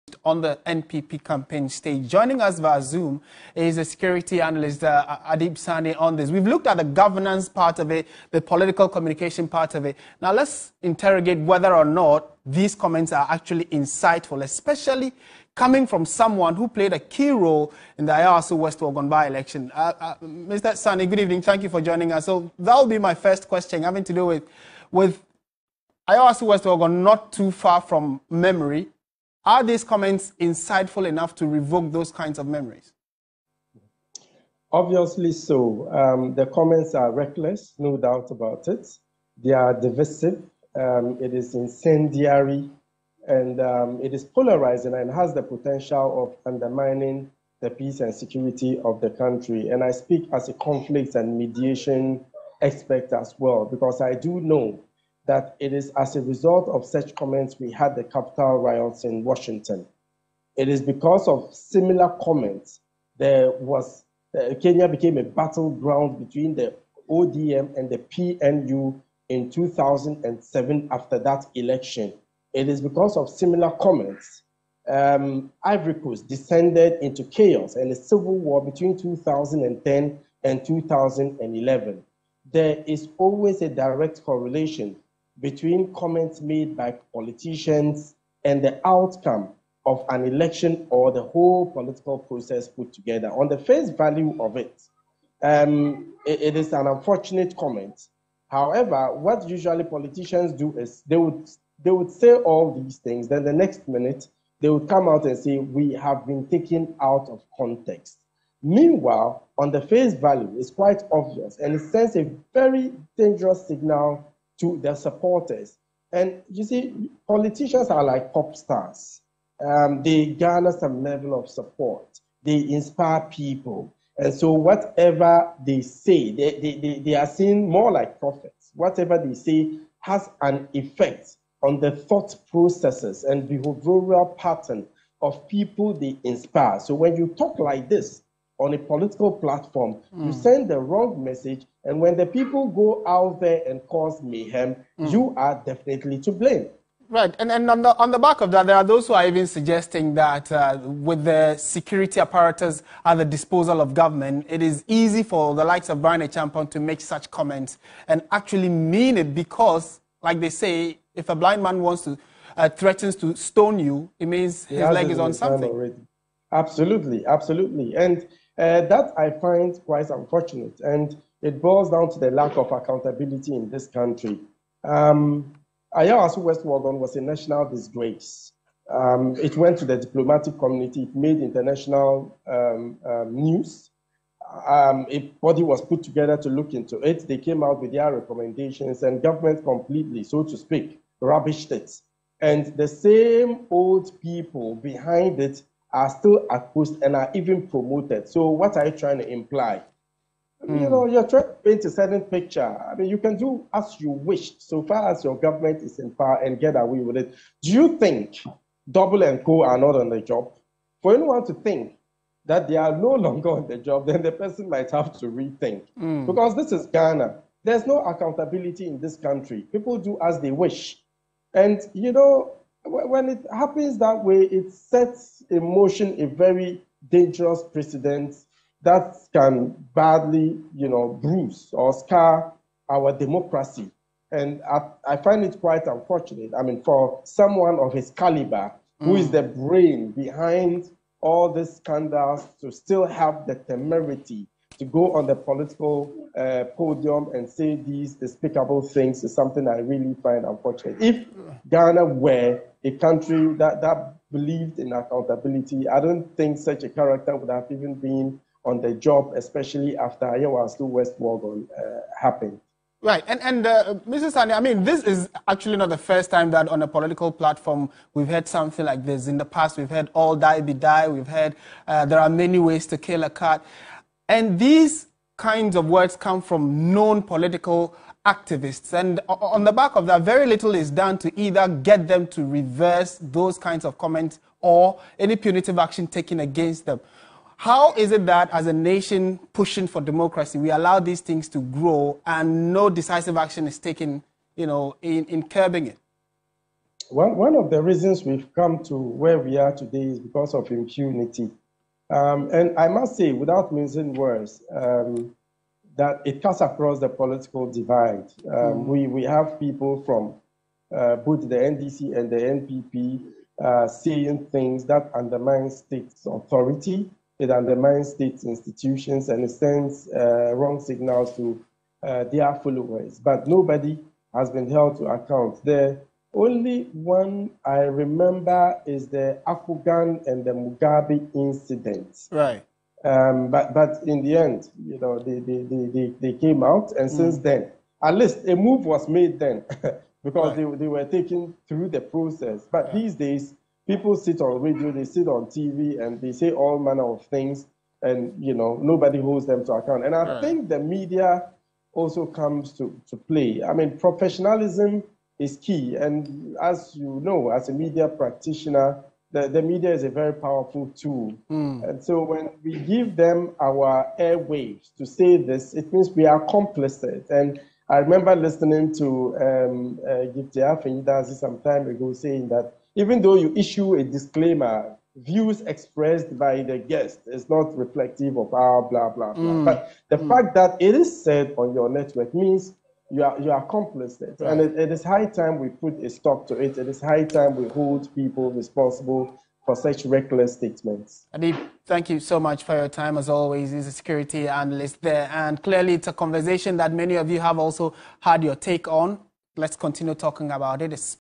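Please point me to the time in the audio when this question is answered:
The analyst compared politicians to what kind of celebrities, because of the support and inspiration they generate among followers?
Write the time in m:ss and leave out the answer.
1:58.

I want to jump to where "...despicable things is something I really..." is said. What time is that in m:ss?
4:08.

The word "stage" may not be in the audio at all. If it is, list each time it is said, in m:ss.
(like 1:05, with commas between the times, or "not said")
0:01.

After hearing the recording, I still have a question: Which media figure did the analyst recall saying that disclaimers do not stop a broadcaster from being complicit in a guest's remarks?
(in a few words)
Gifty Afenyi-Dadzie.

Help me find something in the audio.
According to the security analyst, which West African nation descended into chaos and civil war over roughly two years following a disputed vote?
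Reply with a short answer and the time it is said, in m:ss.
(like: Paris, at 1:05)
Ivory Coast, at 1:15.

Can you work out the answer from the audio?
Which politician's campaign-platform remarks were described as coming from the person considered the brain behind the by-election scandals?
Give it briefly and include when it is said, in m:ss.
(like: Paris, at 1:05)
Bryan Acheampong, at 2:36.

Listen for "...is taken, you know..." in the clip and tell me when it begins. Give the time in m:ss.
4:53.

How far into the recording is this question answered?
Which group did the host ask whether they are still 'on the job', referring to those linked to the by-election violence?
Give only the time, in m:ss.
3:28.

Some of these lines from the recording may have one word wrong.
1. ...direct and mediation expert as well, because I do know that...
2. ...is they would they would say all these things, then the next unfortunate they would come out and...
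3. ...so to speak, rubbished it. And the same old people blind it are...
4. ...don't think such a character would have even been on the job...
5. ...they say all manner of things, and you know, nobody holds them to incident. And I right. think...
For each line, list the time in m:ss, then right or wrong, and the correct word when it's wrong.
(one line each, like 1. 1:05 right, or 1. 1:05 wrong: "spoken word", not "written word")
1. 0:50 wrong: "conflict", not "direct"
2. 1:40 wrong: "minute", not "unfortunate"
3. 3:10 wrong: "behind", not "blind"
4. 4:15 right
5. 5:46 wrong: "account", not "incident".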